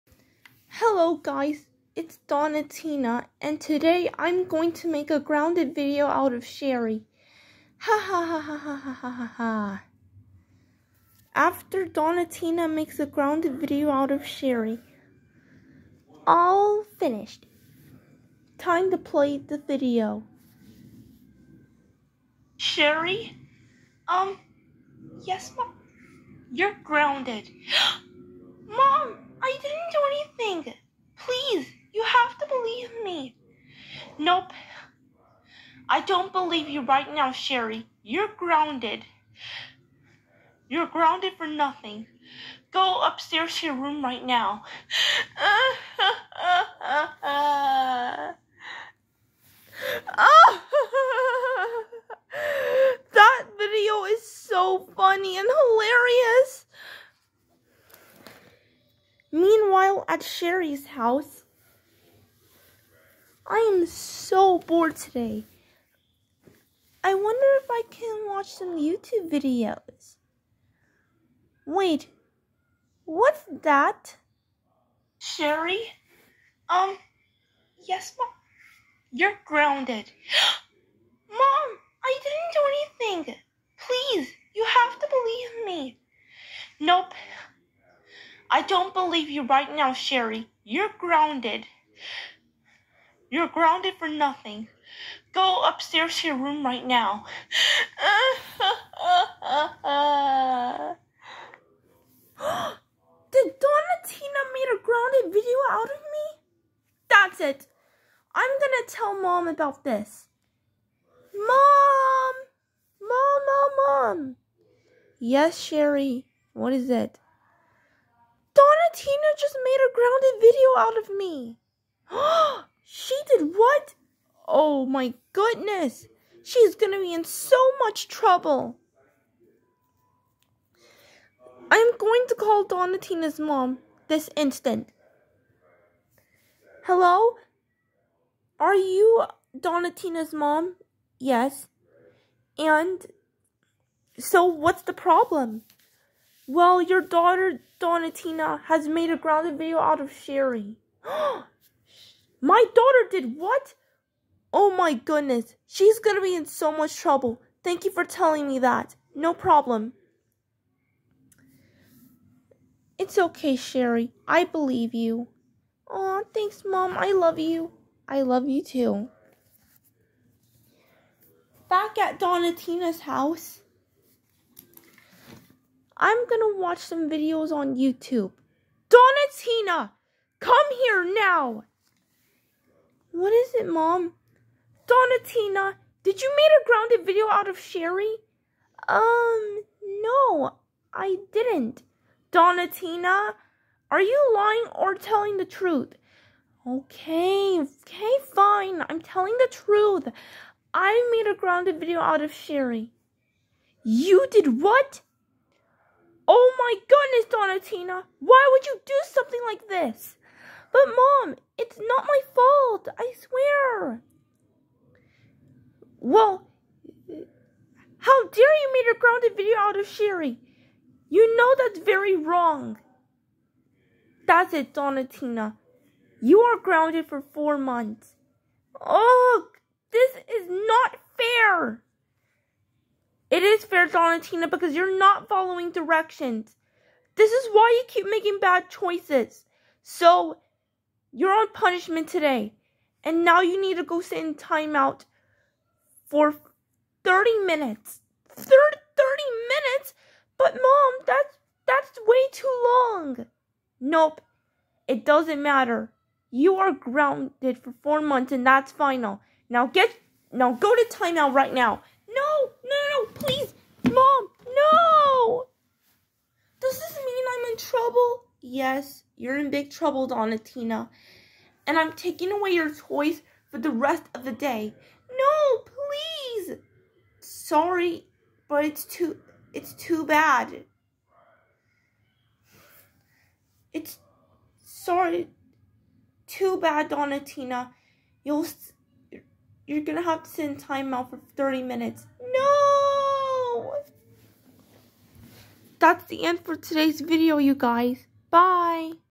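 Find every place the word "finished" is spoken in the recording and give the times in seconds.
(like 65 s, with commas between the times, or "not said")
16 s.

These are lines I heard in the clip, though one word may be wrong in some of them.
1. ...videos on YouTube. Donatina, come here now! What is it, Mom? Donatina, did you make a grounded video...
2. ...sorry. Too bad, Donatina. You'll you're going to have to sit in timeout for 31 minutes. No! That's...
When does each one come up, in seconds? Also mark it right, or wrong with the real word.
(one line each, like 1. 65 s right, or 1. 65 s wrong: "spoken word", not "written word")
1. 177 s right
2. 284 s wrong: "30", not "31".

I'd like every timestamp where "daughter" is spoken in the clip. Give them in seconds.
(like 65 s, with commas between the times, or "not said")
146 s, 152 s.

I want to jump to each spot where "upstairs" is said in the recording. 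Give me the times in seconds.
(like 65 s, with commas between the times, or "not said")
43 s, 95 s.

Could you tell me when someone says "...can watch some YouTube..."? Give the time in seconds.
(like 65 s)
67 s.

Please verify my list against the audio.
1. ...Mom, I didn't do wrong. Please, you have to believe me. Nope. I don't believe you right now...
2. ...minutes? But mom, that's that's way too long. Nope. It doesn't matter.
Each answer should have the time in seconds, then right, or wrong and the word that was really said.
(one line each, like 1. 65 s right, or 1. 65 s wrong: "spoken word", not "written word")
1. 81 s wrong: "anything", not "wrong"
2. 249 s right.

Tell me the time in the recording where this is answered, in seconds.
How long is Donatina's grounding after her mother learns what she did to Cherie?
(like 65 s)
227 s.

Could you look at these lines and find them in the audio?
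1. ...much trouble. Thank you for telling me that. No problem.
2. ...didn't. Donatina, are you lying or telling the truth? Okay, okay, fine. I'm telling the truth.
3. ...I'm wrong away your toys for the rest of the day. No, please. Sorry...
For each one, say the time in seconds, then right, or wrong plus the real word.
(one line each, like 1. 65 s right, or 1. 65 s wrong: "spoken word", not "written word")
1. 156 s right
2. 191 s right
3. 271 s wrong: "taking", not "wrong".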